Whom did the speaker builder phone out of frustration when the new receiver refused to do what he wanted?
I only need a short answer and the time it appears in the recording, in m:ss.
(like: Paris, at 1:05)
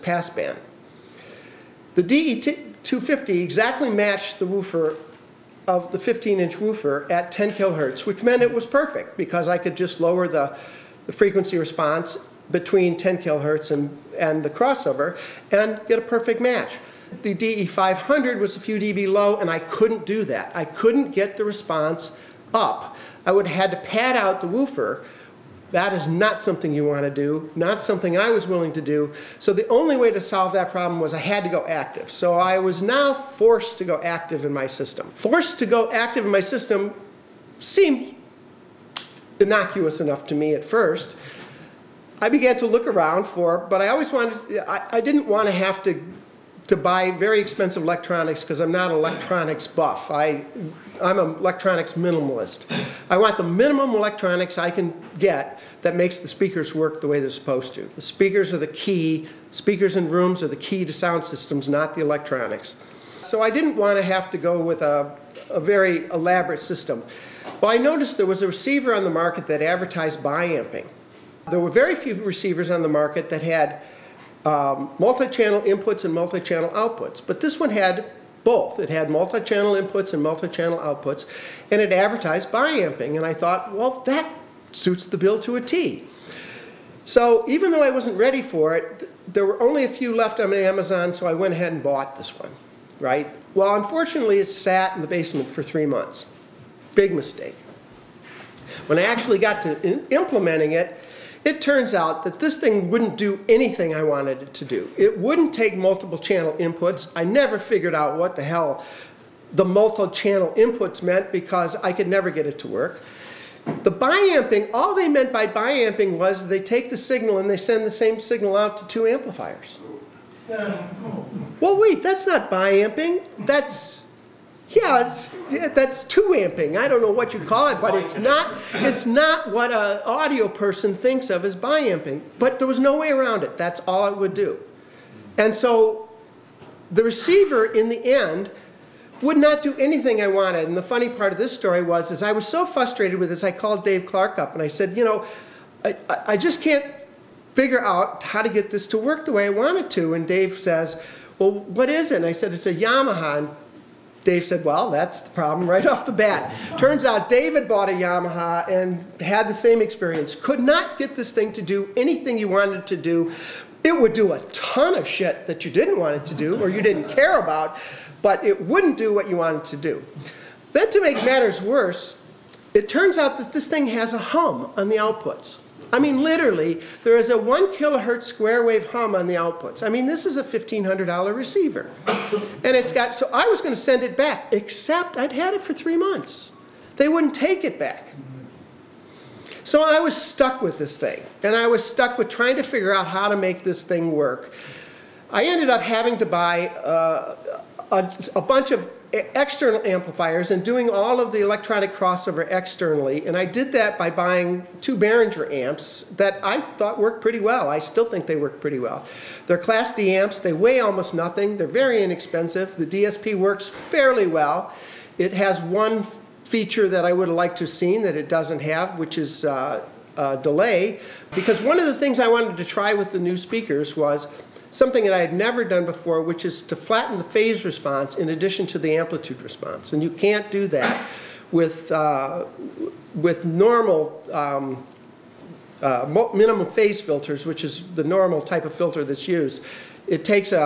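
Dave Clark, at 2:23.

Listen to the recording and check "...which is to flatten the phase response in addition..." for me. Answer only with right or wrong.
right.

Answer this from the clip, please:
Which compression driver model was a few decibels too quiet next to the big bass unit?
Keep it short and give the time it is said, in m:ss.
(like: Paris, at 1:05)
DE500, at 0:17.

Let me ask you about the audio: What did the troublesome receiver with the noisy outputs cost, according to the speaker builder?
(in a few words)
$1,500.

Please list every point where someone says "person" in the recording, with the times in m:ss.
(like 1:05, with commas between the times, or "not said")
2:10.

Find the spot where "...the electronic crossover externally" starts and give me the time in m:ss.
3:21.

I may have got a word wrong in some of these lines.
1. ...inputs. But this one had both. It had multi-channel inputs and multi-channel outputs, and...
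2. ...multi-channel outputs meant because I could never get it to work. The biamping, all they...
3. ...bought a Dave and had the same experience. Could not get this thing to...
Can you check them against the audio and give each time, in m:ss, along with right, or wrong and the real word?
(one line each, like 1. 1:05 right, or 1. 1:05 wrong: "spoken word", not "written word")
1. 1:16 wrong: "outputs", not "inputs"
2. 1:49 wrong: "inputs", not "outputs"
3. 2:37 wrong: "Yamaha", not "Dave".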